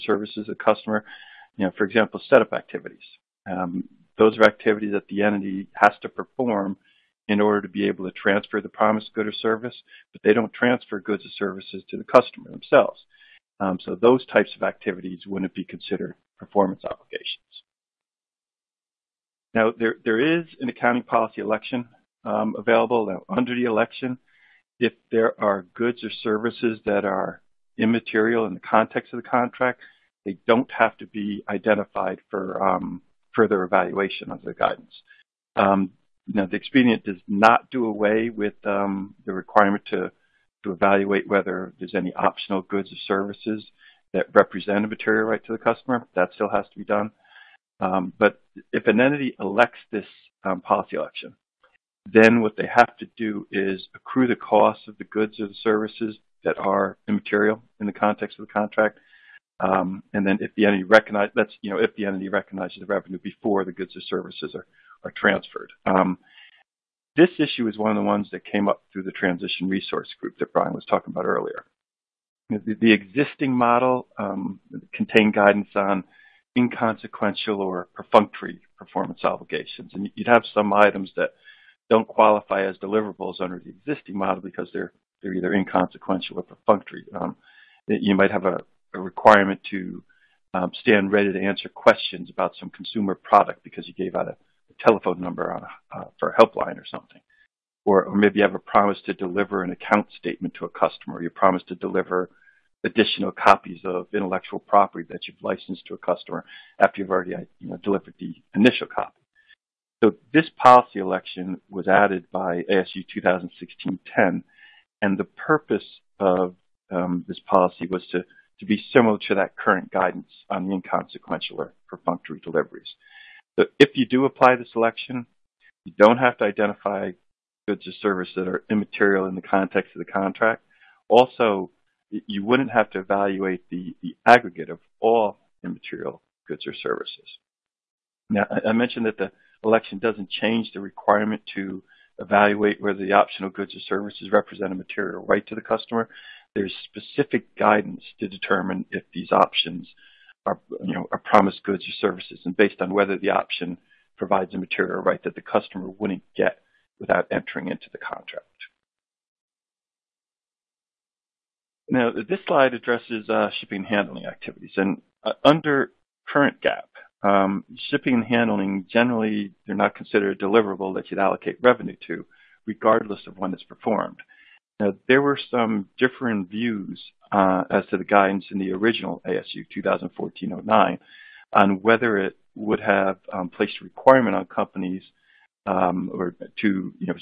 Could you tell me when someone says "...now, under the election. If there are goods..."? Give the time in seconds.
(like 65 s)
23 s.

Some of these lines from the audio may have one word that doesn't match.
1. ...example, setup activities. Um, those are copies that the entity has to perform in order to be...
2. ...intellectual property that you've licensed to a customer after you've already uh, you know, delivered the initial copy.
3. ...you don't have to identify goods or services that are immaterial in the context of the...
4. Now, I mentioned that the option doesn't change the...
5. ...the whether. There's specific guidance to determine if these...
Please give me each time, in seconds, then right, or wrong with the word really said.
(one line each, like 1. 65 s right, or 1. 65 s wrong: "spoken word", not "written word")
1. 1 s wrong: "activities", not "copies"
2. 104 s right
3. 125 s right
4. 138 s wrong: "election", not "option"
5. 145 s wrong: "customer", not "whether".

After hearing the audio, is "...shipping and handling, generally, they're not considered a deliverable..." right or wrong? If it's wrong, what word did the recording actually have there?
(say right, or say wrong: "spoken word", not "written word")
right.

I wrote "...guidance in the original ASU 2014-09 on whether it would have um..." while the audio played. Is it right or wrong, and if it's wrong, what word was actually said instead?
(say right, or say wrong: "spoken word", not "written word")
right.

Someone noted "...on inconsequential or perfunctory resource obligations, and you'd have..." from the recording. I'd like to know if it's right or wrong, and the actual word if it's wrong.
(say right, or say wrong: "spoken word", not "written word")
wrong: "performance", not "resource".